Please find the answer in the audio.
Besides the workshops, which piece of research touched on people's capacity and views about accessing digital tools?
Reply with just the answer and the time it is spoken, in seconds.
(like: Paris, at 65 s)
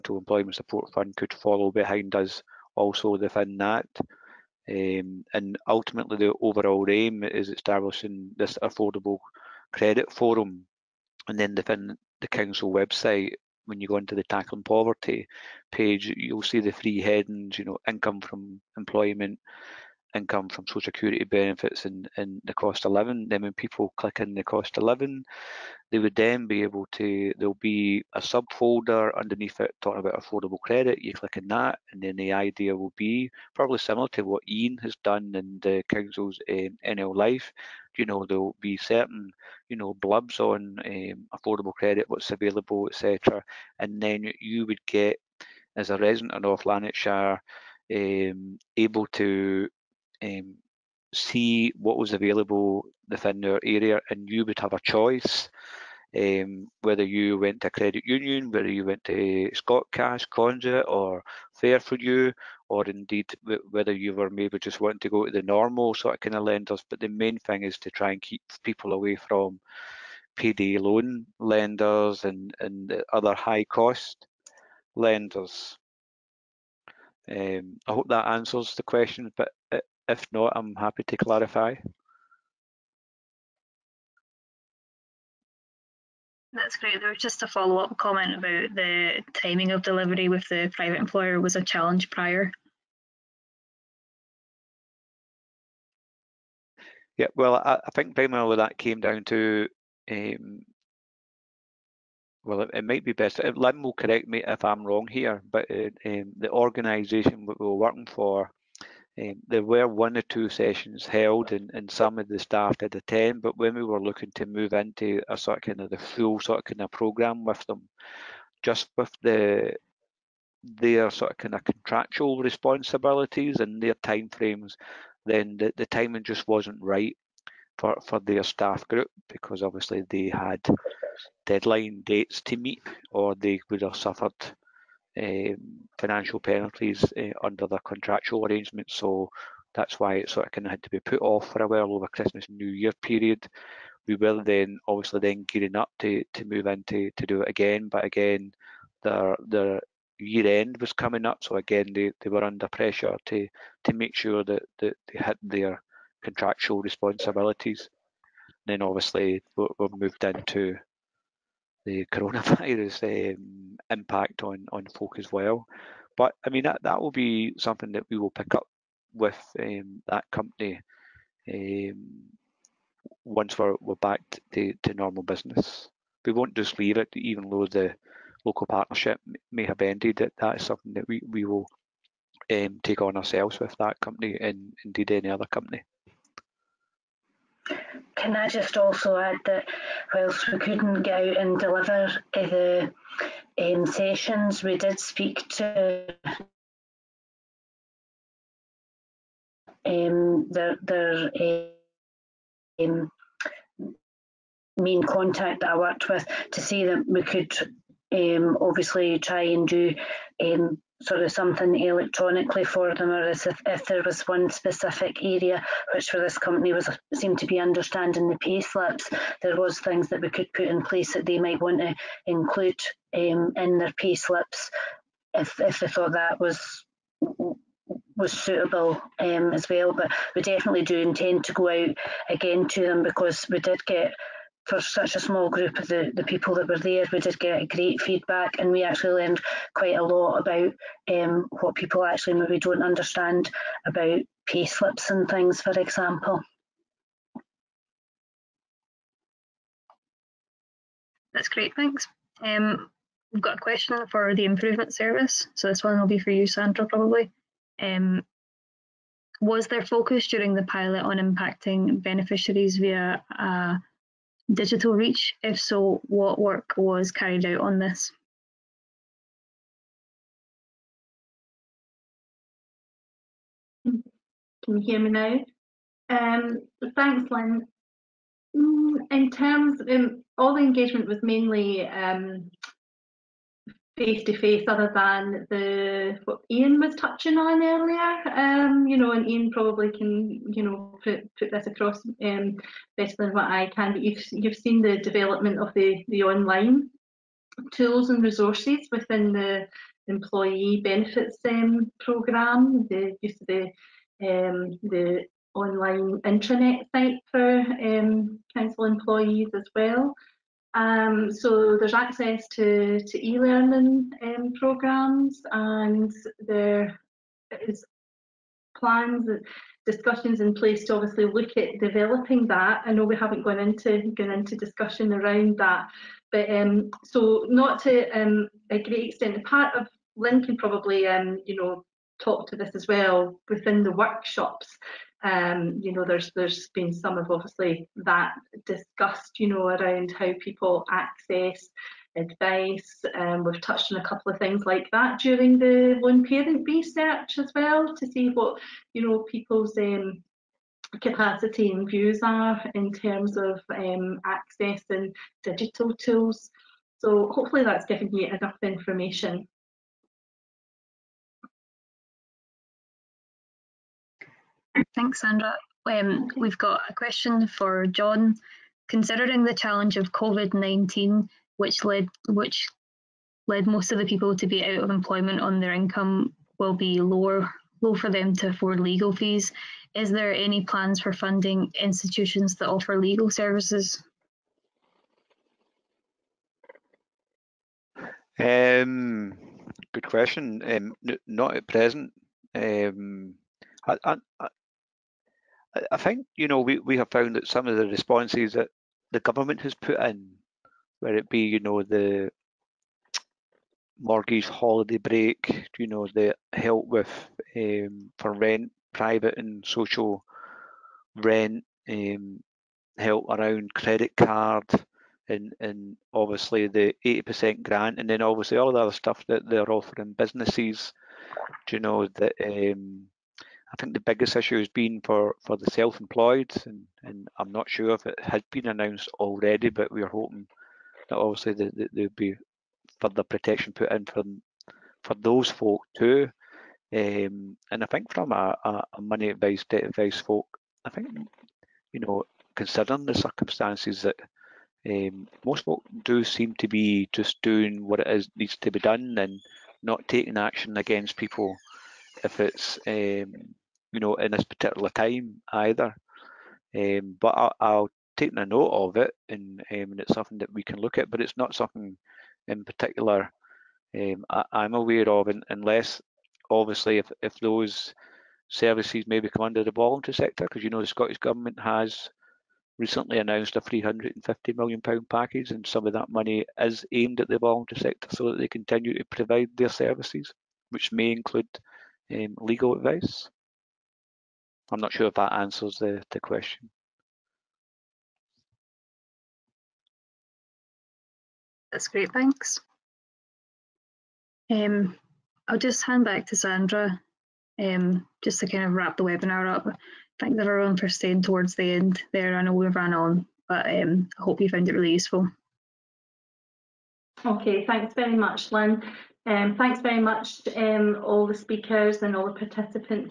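lone parent research, at 346 s.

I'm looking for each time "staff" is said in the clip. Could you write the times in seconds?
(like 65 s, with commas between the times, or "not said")
112 s, 128 s.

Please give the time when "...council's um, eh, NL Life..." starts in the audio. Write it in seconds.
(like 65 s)
35 s.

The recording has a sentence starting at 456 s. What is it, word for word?
Um, but I'll, I'll take a note of it, and, um, and it's something that we can look at.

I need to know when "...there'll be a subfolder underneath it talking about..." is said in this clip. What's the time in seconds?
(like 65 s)
27 s.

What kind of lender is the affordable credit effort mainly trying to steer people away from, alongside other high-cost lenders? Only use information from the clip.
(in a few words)
payday loan lenders.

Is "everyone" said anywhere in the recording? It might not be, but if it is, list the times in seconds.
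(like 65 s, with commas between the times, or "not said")
500 s.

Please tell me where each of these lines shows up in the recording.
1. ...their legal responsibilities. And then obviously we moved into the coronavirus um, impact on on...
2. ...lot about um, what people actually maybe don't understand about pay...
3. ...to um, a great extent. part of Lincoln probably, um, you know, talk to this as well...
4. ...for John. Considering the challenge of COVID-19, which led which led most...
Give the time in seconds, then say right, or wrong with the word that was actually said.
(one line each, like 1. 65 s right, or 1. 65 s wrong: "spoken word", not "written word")
1. 155 s wrong: "contractual", not "legal"
2. 240 s right
3. 327 s right
4. 367 s right.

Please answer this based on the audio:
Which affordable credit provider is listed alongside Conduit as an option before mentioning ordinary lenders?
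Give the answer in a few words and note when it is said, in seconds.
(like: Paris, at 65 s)
Fair for You, at 61 s.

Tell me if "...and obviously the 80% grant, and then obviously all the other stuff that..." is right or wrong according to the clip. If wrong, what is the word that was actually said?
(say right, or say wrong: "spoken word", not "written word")
right.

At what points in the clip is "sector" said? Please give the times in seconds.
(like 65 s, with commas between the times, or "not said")
470 s, 477 s.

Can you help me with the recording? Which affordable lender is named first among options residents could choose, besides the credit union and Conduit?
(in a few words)
Scotcash.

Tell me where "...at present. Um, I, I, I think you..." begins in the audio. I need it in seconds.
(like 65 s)
391 s.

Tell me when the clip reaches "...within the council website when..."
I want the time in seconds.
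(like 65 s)
11 s.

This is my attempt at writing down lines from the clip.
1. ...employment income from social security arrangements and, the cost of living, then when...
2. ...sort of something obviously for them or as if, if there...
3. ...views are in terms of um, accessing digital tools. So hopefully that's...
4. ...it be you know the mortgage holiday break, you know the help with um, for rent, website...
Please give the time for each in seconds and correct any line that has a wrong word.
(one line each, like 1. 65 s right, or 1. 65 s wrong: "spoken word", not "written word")
1. 18 s wrong: "benefits", not "arrangements"
2. 211 s wrong: "electronically", not "obviously"
3. 351 s right
4. 401 s wrong: "private", not "website".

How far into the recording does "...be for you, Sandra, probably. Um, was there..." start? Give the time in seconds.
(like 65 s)
256 s.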